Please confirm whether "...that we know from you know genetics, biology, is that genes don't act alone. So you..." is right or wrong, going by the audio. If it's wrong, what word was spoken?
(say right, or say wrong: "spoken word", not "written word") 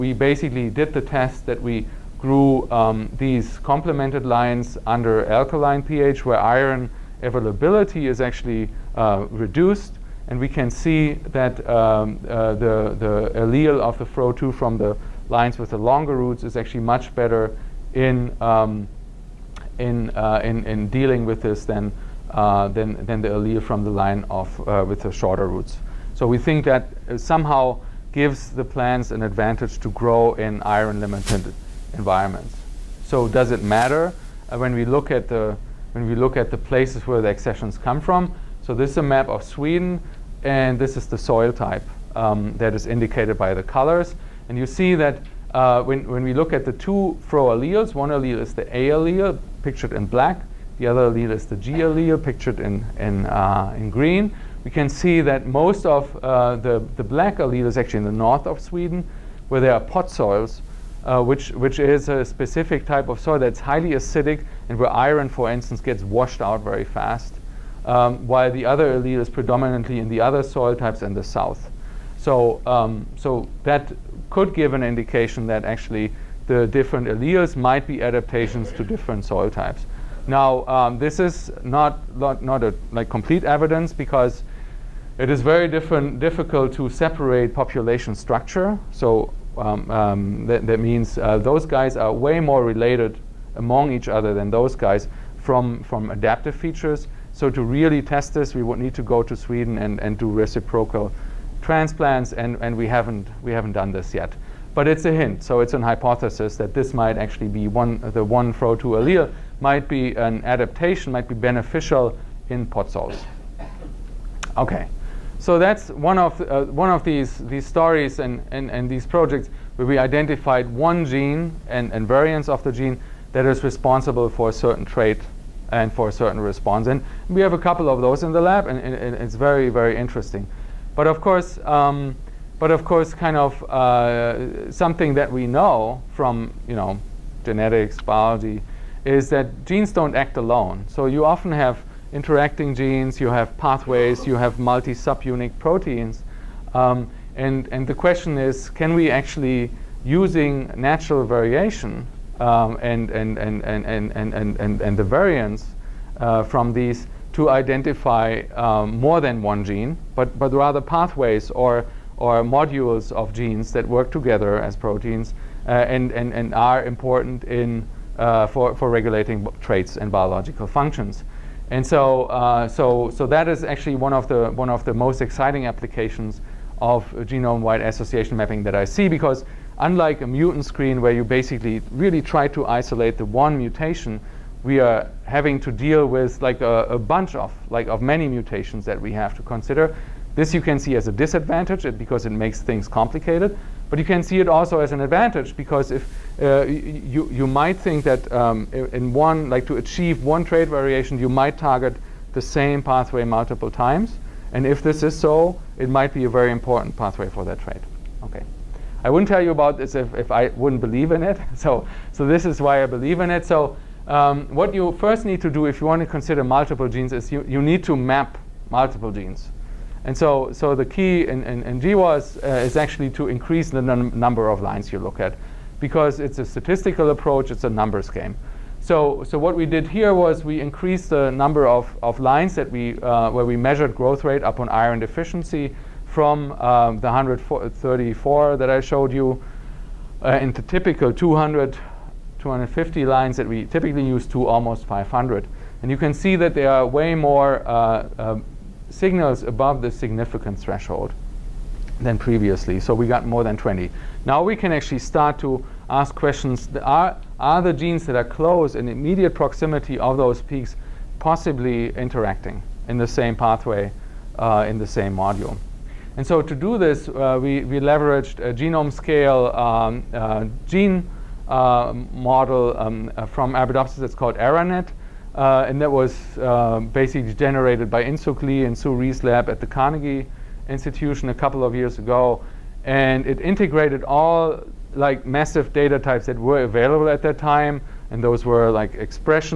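right.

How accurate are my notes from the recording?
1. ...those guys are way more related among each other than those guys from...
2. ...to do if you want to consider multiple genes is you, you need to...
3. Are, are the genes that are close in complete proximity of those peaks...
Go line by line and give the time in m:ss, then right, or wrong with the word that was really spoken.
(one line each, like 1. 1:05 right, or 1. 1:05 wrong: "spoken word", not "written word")
1. 1:31 right
2. 3:35 right
3. 4:16 wrong: "immediate", not "complete".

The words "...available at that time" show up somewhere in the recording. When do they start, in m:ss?
4:46.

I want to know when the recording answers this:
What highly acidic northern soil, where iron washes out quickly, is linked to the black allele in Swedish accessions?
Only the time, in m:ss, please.
0:59.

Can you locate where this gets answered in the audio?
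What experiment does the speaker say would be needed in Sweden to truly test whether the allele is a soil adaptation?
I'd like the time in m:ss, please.
1:40.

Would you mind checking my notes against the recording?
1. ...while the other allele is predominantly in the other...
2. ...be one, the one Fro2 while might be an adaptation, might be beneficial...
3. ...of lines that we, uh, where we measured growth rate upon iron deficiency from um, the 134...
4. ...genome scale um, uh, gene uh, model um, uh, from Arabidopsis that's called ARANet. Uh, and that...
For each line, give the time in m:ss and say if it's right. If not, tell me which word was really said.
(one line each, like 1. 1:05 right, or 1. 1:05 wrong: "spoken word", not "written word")
1. 1:08 right
2. 1:47 wrong: "allele", not "while"
3. 3:52 right
4. 4:28 right.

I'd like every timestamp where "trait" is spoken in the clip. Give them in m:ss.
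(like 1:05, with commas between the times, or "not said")
2:04, 2:49.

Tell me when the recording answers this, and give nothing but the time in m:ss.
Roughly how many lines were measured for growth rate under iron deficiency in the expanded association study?
4:04.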